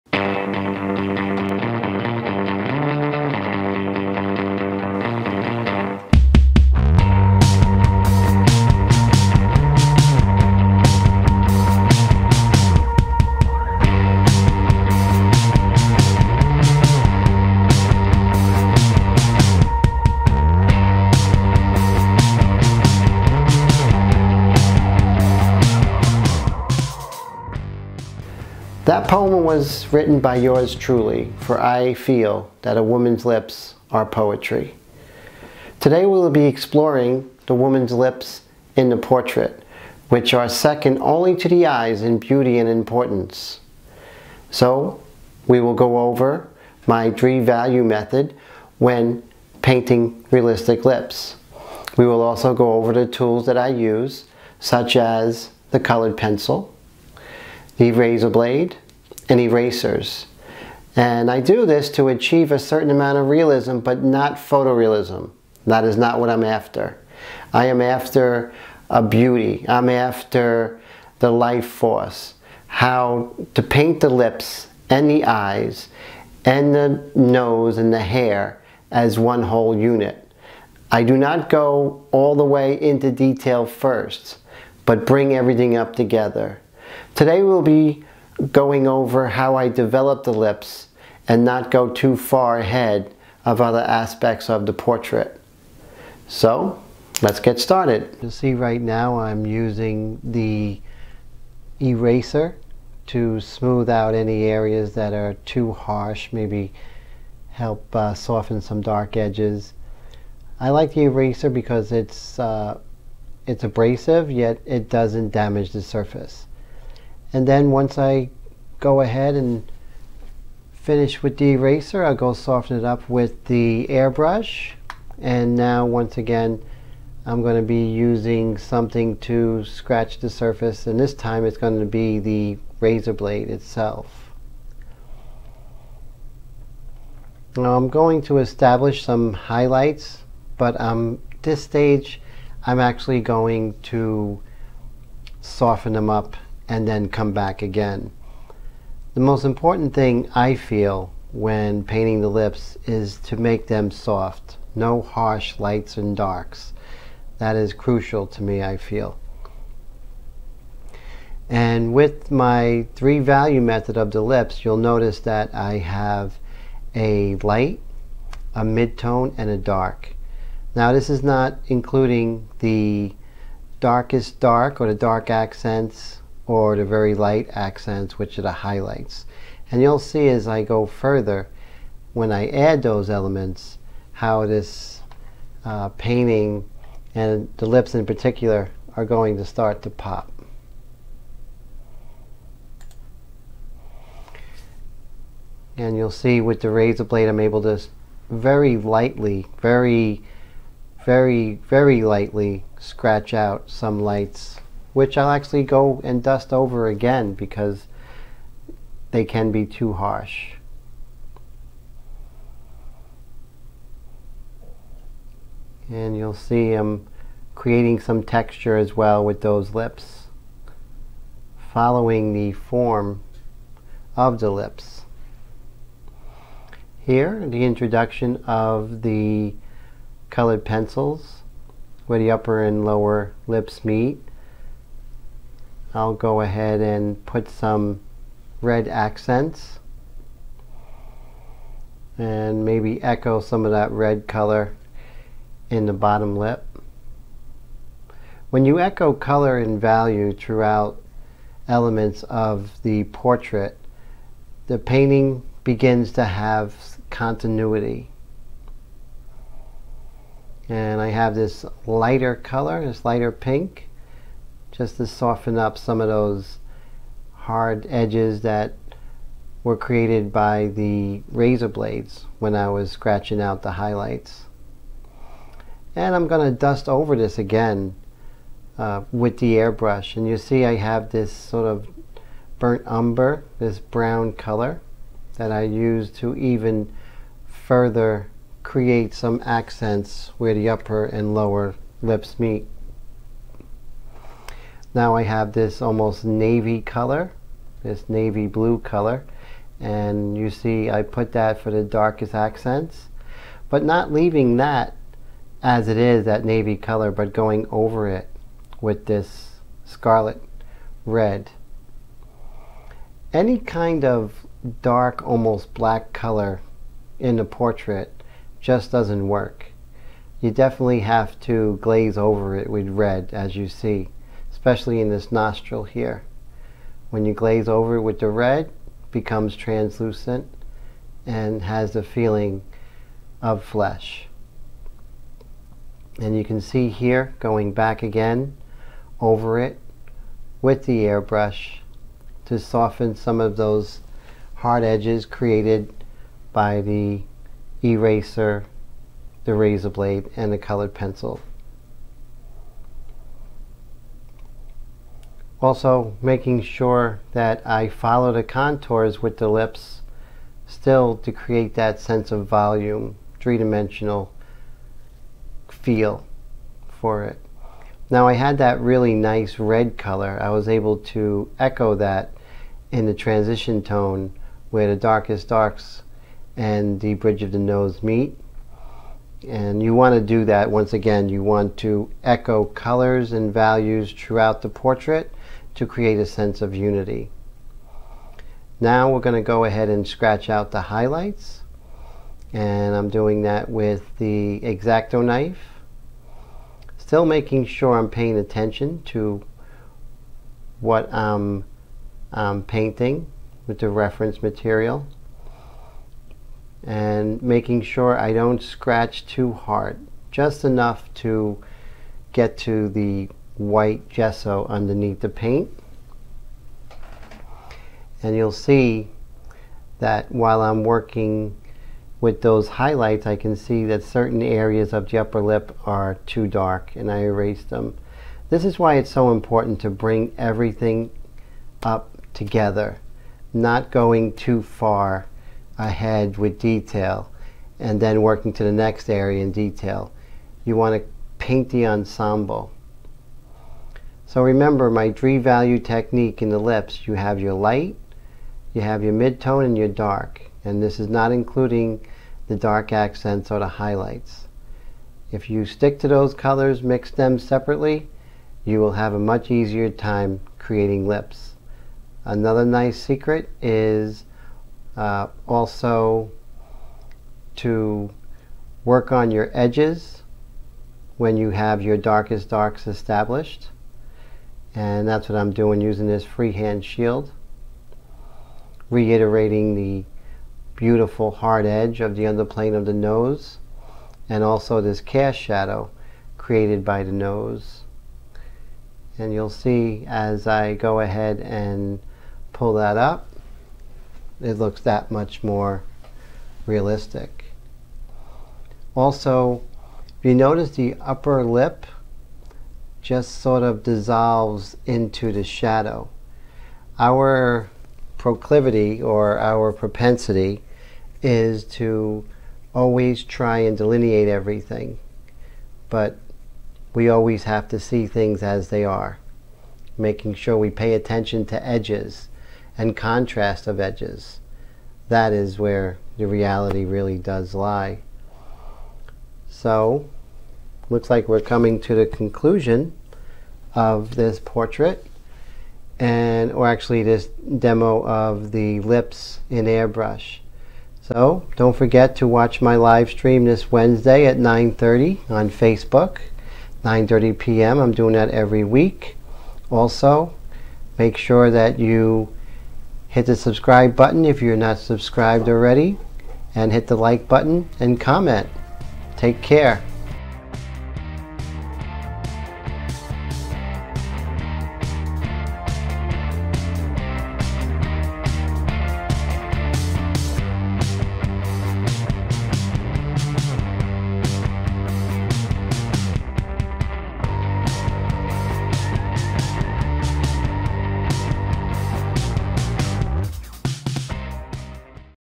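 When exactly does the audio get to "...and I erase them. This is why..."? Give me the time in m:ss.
7:06.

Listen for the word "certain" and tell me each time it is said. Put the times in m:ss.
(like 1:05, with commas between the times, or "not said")
1:02, 7:04.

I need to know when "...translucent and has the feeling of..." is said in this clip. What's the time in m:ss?
5:29.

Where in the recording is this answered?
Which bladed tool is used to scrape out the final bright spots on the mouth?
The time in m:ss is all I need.
6:34.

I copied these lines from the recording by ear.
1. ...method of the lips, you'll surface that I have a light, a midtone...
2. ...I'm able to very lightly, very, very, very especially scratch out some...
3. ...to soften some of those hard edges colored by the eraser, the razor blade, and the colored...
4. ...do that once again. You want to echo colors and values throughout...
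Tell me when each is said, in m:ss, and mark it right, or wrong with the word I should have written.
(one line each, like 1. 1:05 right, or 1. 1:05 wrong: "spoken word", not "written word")
1. 2:43 wrong: "notice", not "surface"
2. 3:17 wrong: "lightly", not "especially"
3. 5:42 wrong: "created", not "colored"
4. 6:20 right.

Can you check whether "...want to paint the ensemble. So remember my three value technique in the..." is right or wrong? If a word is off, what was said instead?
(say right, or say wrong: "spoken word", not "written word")
right.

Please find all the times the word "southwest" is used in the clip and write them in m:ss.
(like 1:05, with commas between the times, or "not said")
not said.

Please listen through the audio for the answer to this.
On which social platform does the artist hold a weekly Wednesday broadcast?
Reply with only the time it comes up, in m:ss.
9:05.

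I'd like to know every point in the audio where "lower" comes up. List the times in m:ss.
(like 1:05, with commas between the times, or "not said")
3:52, 4:51.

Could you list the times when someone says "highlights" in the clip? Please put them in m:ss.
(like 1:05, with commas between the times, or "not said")
2:19, 2:58, 4:33, 6:30, 7:02, 7:33.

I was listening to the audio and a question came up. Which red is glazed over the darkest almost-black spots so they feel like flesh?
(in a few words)
Scarlet red.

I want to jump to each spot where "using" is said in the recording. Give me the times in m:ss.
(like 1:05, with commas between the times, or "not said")
1:39, 2:07, 7:55.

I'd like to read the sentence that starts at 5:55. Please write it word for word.
Also making sure that I follow the contours with the lips still to create that sense of volume, three-dimensional feel for it.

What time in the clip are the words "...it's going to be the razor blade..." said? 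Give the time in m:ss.
2:11.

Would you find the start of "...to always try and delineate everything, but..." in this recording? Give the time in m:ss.
8:31.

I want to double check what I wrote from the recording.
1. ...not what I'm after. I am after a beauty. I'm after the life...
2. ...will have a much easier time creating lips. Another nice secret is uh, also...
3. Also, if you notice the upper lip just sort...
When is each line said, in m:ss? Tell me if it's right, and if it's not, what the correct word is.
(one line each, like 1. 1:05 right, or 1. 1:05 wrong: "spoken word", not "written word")
1. 1:05 right
2. 7:38 right
3. 8:18 right.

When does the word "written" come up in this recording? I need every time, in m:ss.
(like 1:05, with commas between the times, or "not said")
0:29.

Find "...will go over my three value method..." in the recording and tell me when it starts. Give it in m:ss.
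0:45.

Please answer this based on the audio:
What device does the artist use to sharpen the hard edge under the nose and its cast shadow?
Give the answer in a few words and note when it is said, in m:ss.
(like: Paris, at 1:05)
Freehand shield, at 7:56.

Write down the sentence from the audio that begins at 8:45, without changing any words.
That is where the reality really does lie.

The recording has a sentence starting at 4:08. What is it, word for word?
When you echo color and value throughout elements of the portrait, the painting begins to have continuity.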